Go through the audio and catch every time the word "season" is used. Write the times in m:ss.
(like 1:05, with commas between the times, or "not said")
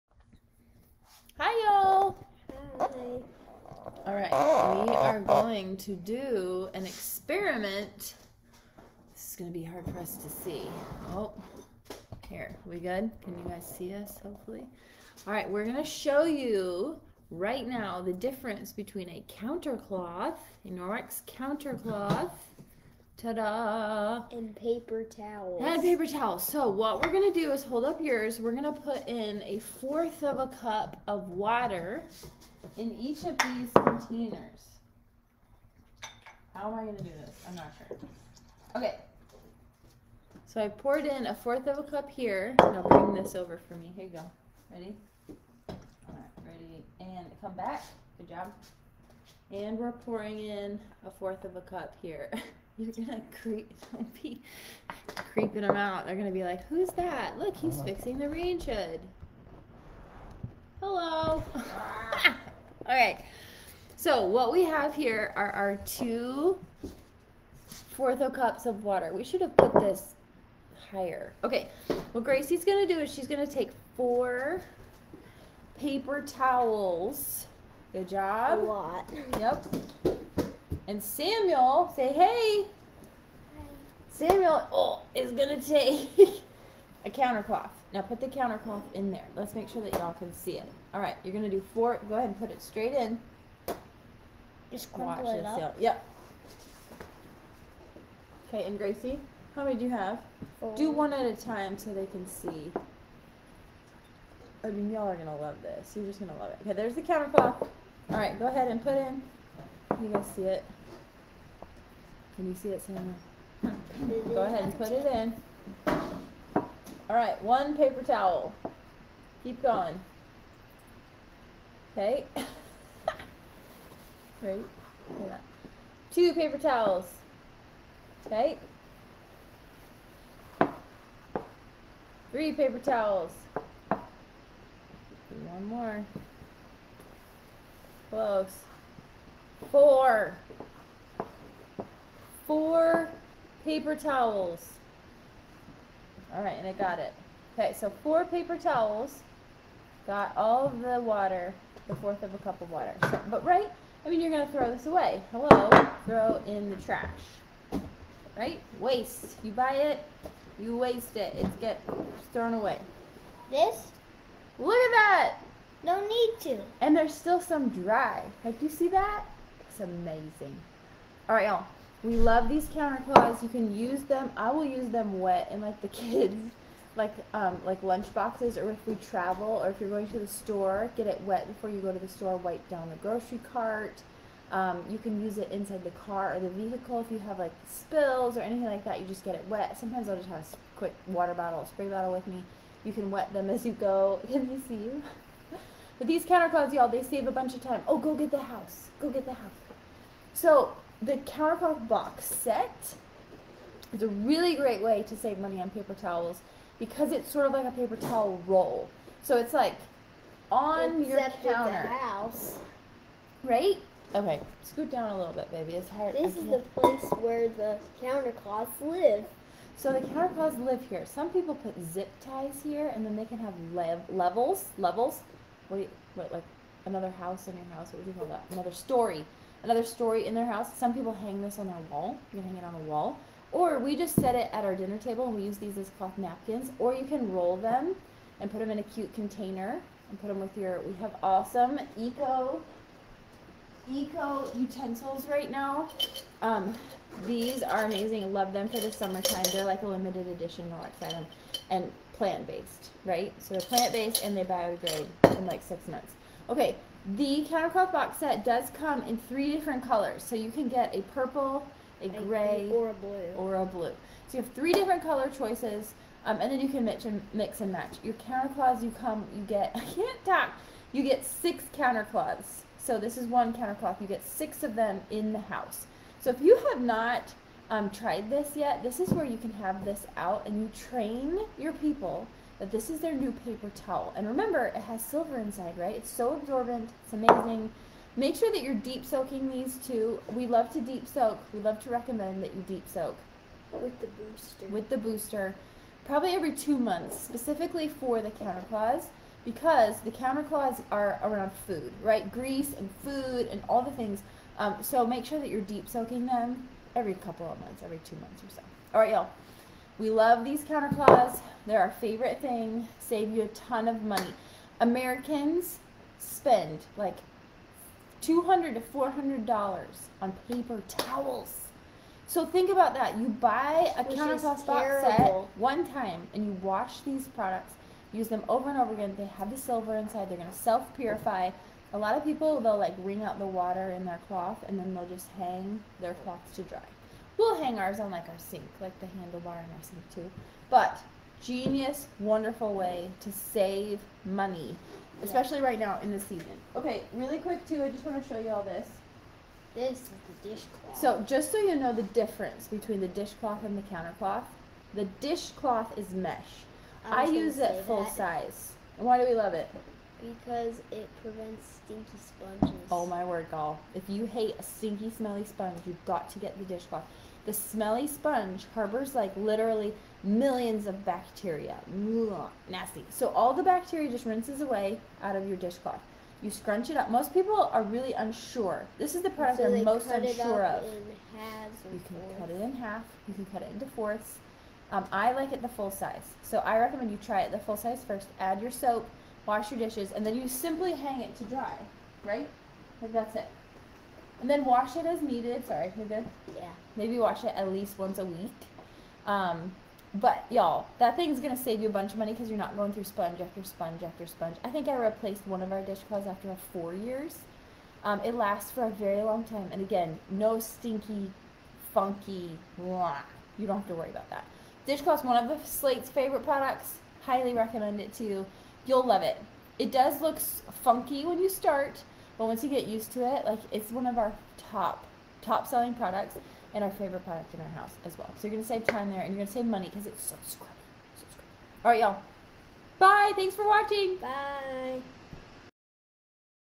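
5:46.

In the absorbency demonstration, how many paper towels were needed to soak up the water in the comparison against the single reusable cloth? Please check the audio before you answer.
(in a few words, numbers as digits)
4.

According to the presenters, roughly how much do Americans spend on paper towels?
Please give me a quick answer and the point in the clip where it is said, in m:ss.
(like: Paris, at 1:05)
$200 to $400, at 5:18.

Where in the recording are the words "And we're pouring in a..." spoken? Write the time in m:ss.
0:49.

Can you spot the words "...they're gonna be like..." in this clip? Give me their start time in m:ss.
0:56.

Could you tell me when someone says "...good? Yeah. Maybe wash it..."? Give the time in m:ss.
6:36.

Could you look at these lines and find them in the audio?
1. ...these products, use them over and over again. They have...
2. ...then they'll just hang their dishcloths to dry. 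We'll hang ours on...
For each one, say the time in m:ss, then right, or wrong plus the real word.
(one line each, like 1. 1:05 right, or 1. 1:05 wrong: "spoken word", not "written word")
1. 5:27 right
2. 5:34 wrong: "cloths", not "dishcloths".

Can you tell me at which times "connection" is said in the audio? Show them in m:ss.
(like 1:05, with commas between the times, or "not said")
not said.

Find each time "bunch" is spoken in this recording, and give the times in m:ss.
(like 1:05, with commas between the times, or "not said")
3:17, 6:41.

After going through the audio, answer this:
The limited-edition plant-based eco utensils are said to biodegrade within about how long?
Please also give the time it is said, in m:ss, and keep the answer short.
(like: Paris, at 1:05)
6 months, at 4:15.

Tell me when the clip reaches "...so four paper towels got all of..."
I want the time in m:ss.
2:27.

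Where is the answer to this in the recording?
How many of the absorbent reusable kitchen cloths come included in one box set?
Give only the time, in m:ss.
4:30.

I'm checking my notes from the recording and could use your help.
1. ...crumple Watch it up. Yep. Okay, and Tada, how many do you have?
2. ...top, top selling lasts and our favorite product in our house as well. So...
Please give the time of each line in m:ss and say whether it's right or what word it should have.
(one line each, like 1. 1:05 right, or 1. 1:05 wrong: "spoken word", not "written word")
1. 1:34 wrong: "Gracie", not "Tada"
2. 7:04 wrong: "products", not "lasts".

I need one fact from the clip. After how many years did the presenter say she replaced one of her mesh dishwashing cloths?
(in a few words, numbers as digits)
4 years.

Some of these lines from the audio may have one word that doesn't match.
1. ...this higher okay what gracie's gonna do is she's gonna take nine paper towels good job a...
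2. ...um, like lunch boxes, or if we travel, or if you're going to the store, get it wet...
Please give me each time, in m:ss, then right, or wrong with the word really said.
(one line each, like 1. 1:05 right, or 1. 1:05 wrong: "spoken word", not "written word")
1. 1:09 wrong: "four", not "nine"
2. 2:57 right.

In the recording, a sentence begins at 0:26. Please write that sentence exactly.
So what we're gonna do is hold up yours.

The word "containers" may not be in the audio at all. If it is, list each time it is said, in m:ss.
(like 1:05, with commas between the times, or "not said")
0:33, 3:59.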